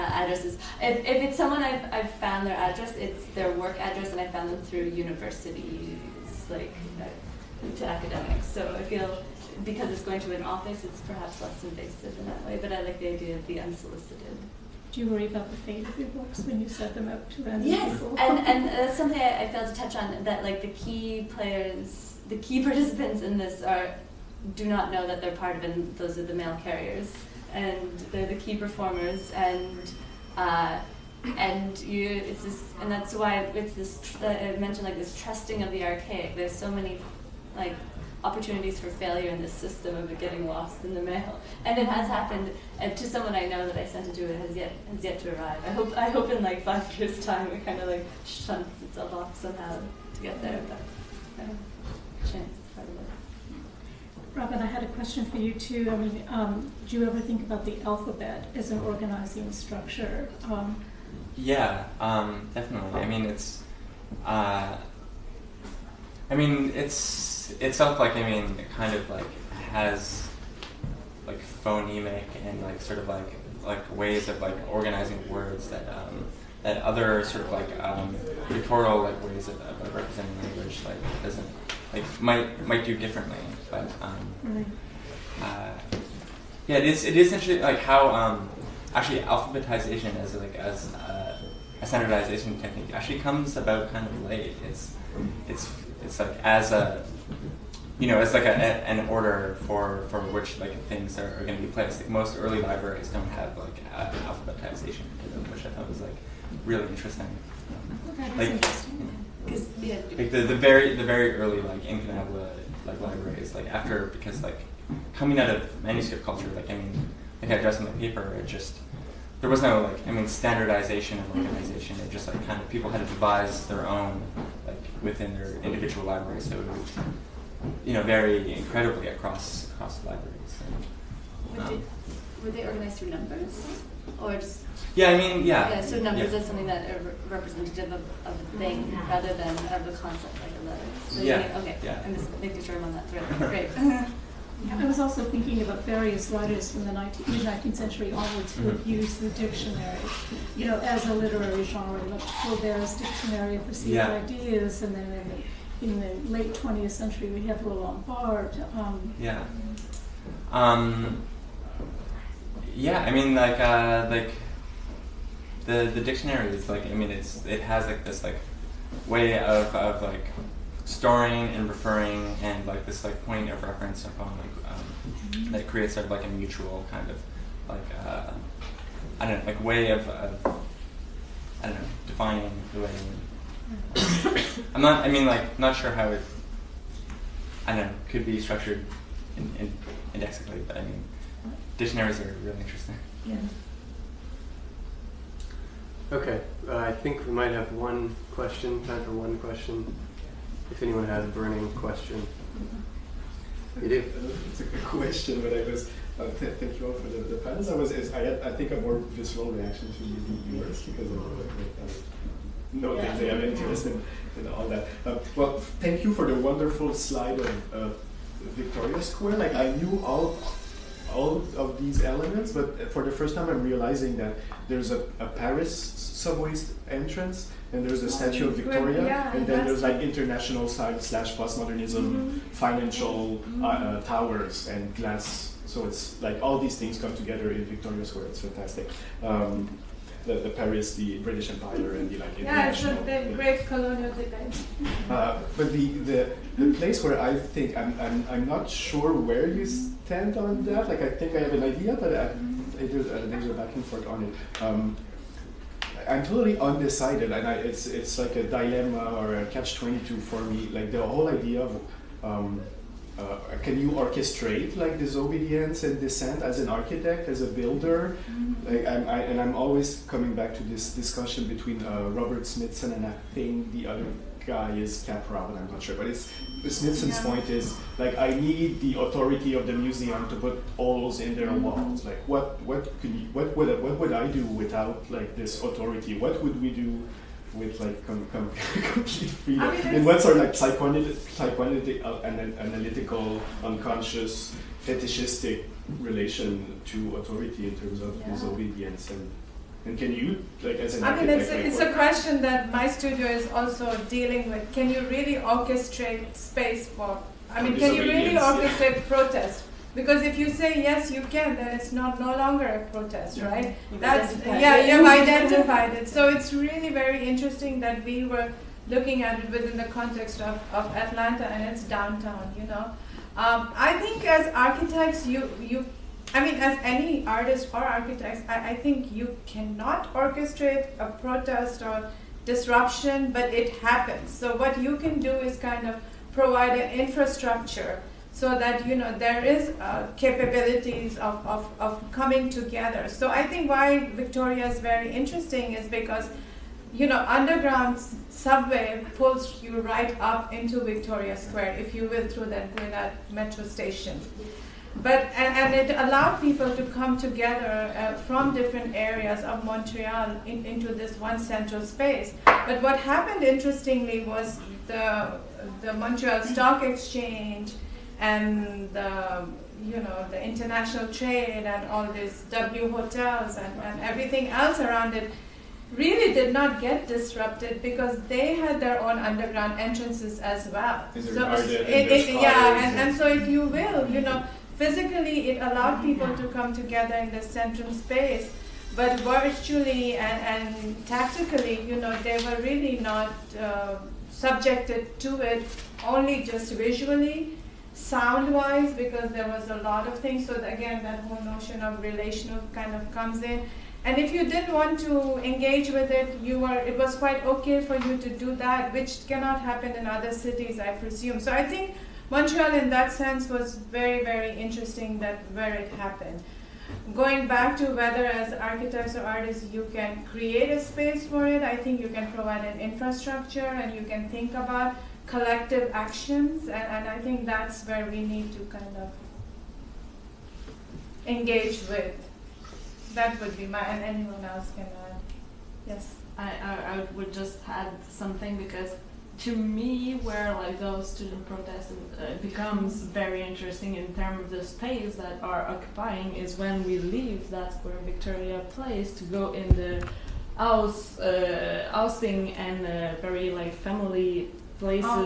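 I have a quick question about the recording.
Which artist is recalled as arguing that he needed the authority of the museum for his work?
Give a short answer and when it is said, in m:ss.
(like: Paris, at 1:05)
Robert Smithson, at 4:32.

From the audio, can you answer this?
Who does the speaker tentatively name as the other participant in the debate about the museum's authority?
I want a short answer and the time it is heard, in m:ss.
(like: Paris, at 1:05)
Kaprow, at 4:35.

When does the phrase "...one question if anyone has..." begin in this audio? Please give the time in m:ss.
3:19.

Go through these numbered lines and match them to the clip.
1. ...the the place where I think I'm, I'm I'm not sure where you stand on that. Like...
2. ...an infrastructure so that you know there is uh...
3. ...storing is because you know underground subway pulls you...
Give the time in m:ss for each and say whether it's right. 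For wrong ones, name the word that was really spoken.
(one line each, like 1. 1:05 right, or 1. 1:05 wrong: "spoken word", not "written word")
1. 4:06 right
2. 5:36 right
3. 5:45 wrong: "interesting", not "storing".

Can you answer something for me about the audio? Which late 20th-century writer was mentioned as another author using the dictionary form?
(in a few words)
Roland Barthes.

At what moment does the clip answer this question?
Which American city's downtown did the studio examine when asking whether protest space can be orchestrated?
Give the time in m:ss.
5:20.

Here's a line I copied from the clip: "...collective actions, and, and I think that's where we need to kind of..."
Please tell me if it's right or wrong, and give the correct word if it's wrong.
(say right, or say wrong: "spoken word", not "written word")
right.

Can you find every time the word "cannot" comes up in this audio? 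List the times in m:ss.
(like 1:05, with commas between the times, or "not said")
5:29, 6:49.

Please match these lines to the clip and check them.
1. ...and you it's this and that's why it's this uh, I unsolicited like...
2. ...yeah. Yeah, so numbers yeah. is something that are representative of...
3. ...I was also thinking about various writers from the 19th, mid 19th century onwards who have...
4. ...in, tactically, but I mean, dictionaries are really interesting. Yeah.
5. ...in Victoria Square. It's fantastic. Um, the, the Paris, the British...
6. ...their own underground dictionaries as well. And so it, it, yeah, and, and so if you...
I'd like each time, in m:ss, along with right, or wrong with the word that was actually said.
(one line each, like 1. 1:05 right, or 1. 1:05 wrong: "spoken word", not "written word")
1. 0:31 wrong: "mentioned", not "unsolicited"
2. 2:15 right
3. 2:24 right
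4. 3:09 wrong: "indexically", not "tactically"
5. 3:57 right
6. 6:18 wrong: "entrances", not "dictionaries".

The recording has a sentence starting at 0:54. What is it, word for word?
Robin, I had a question for you too.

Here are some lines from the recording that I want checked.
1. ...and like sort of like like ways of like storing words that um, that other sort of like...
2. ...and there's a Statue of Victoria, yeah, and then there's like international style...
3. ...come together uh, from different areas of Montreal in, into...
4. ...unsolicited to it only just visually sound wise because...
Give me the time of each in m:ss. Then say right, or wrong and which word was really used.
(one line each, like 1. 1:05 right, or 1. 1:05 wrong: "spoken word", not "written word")
1. 1:12 wrong: "organizing", not "storing"
2. 3:47 right
3. 5:56 right
4. 6:34 wrong: "subjected", not "unsolicited".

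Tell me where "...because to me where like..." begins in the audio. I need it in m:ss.
7:18.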